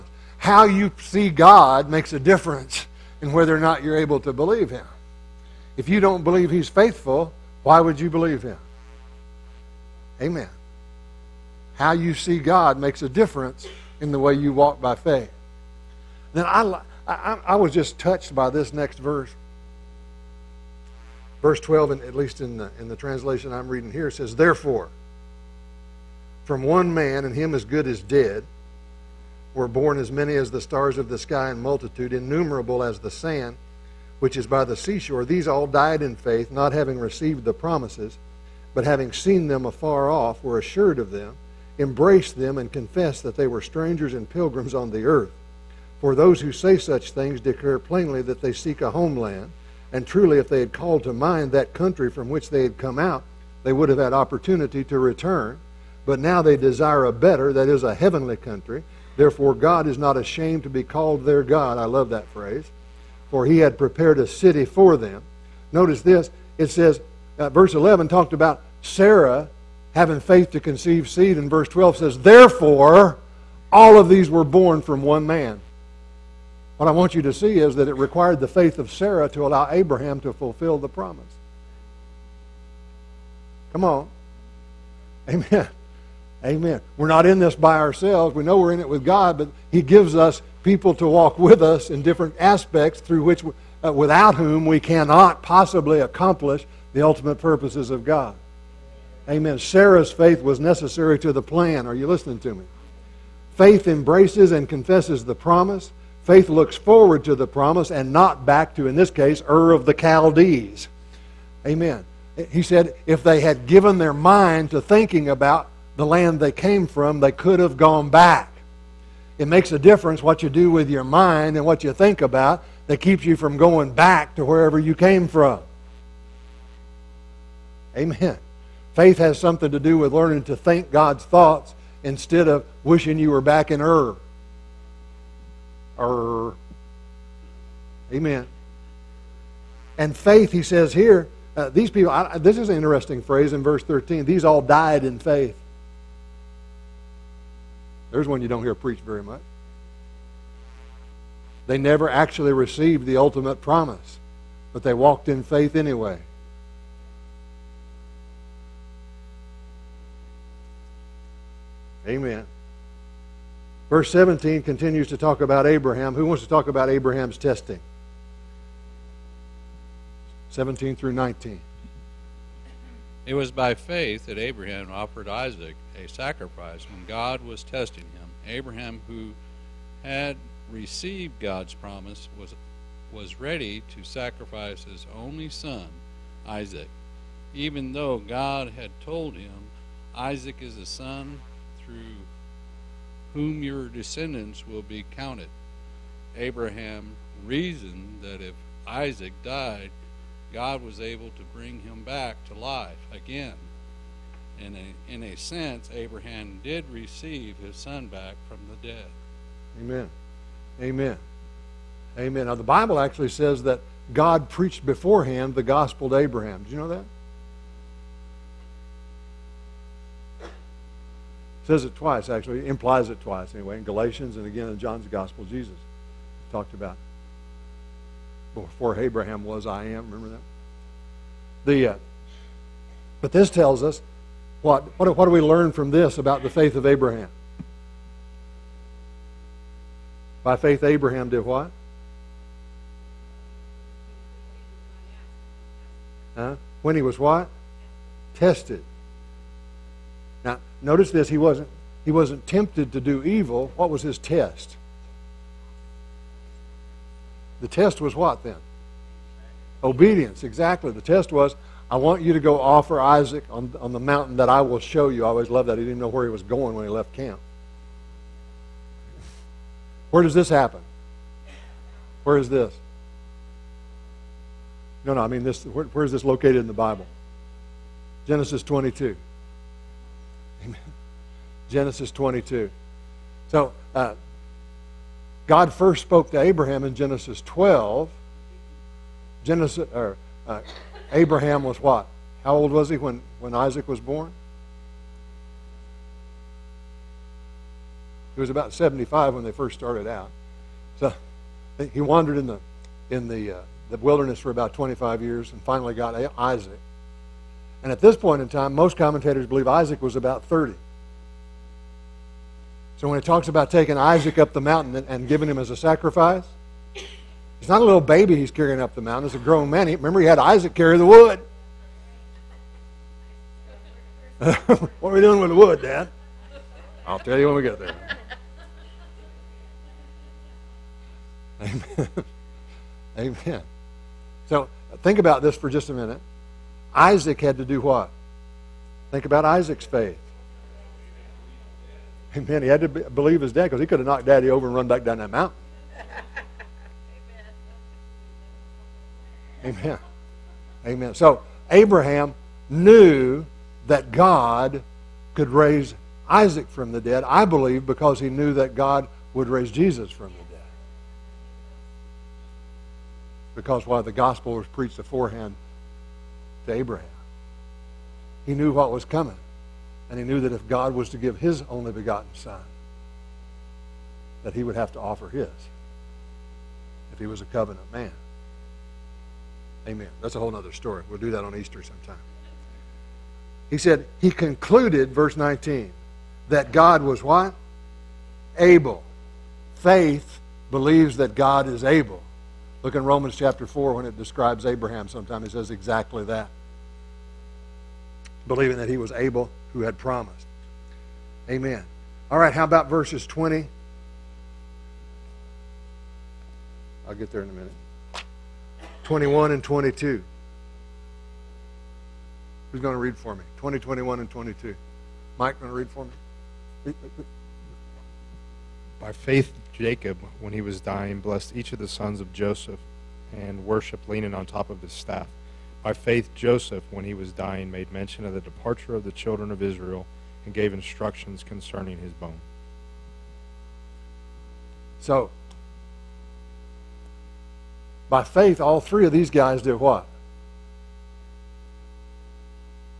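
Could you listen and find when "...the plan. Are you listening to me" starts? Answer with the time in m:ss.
1:41.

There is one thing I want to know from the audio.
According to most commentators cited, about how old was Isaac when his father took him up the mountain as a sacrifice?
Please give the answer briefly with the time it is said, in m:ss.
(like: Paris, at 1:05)
30, at 5:10.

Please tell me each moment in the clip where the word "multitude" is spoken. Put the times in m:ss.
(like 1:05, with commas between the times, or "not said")
0:31.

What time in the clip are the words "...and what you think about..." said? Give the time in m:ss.
2:01.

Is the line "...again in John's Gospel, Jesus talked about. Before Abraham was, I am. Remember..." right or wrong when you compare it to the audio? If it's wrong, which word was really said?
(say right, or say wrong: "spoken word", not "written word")
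right.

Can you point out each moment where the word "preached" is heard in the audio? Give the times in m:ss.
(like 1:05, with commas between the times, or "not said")
2:28, 3:34, 6:04.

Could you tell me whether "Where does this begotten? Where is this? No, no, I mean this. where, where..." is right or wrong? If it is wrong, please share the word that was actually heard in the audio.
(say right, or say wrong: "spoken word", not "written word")
wrong: "happen", not "begotten".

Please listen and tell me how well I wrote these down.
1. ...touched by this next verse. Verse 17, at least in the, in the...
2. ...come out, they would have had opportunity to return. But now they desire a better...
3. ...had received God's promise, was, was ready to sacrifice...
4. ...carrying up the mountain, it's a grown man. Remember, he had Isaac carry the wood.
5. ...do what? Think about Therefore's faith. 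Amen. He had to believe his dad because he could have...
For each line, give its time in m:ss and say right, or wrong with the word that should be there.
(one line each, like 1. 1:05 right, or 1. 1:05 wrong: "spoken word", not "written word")
1. 0:17 wrong: "12", not "17"
2. 0:52 right
3. 3:00 right
4. 5:18 right
5. 5:37 wrong: "Isaac", not "Therefore".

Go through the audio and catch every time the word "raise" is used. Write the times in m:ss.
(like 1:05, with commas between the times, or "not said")
5:55, 5:59.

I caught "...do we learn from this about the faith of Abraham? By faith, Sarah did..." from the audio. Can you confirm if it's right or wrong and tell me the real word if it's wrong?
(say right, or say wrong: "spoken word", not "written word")
wrong: "Abraham", not "Sarah".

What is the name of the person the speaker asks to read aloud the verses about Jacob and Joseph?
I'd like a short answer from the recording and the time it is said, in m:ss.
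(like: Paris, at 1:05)
Mike, at 6:55.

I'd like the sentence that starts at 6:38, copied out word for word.
Believing that he was able who had promised.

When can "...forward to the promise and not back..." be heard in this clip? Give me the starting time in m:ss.
1:46.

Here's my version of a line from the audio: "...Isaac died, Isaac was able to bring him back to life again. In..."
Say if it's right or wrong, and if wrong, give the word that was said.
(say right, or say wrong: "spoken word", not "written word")
wrong: "God", not "Isaac".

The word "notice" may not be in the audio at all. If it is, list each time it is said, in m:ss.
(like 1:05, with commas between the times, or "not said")
1:05, 4:10.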